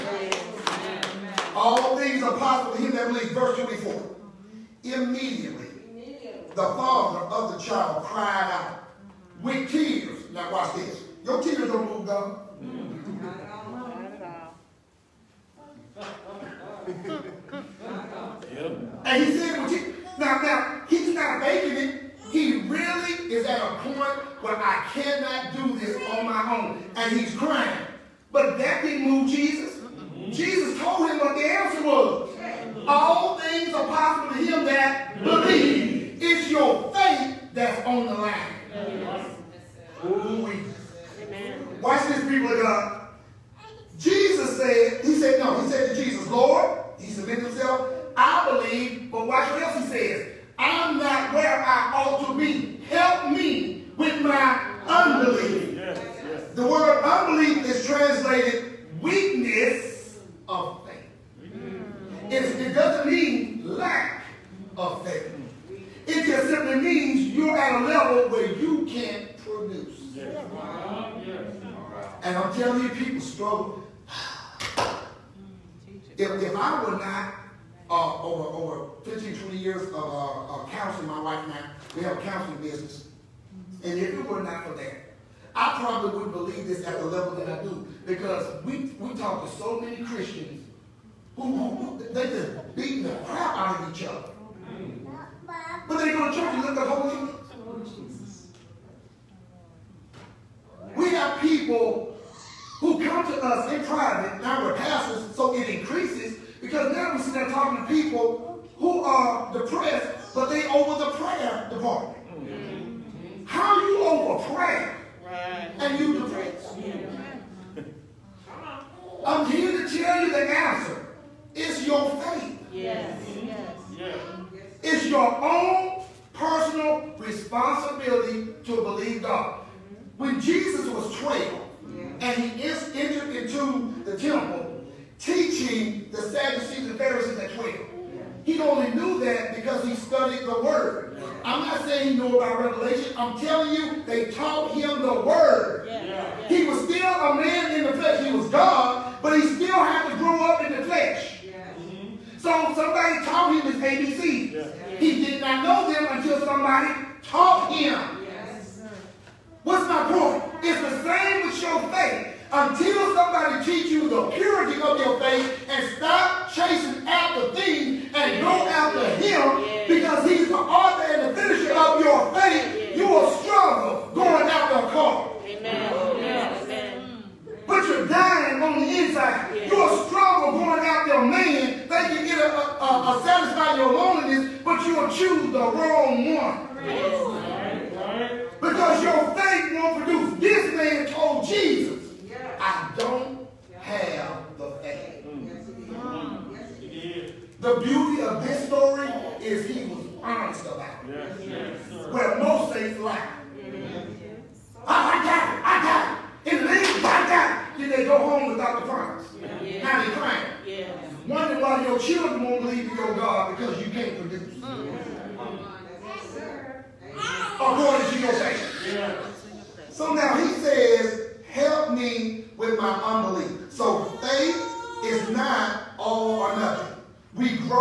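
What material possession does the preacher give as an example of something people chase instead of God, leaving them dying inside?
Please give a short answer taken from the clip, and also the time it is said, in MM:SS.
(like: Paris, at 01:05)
A car, at 02:54.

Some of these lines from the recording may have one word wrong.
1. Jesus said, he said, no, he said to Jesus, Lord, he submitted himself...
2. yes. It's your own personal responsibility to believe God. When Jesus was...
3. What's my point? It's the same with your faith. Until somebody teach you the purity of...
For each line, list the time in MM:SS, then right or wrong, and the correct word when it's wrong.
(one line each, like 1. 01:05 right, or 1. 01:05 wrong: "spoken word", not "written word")
1. 00:43 right
2. 02:03 right
3. 02:39 right.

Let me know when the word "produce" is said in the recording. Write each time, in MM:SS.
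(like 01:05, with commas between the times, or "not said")
03:10, 03:34.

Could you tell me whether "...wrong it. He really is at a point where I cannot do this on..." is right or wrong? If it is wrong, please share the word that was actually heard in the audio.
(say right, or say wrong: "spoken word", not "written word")
wrong: "making", not "wrong".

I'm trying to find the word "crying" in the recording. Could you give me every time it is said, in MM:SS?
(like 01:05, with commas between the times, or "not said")
00:27, 03:30.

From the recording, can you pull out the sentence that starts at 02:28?
He was God, but he still had to grow up in the flesh.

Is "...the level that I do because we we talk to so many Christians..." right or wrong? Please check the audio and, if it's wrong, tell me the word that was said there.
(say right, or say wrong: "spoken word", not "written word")
right.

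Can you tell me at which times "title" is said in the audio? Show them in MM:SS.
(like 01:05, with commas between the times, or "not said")
not said.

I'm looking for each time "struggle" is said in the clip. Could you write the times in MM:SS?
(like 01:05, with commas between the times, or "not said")
02:53, 03:00.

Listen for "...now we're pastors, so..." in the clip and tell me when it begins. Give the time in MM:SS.
01:44.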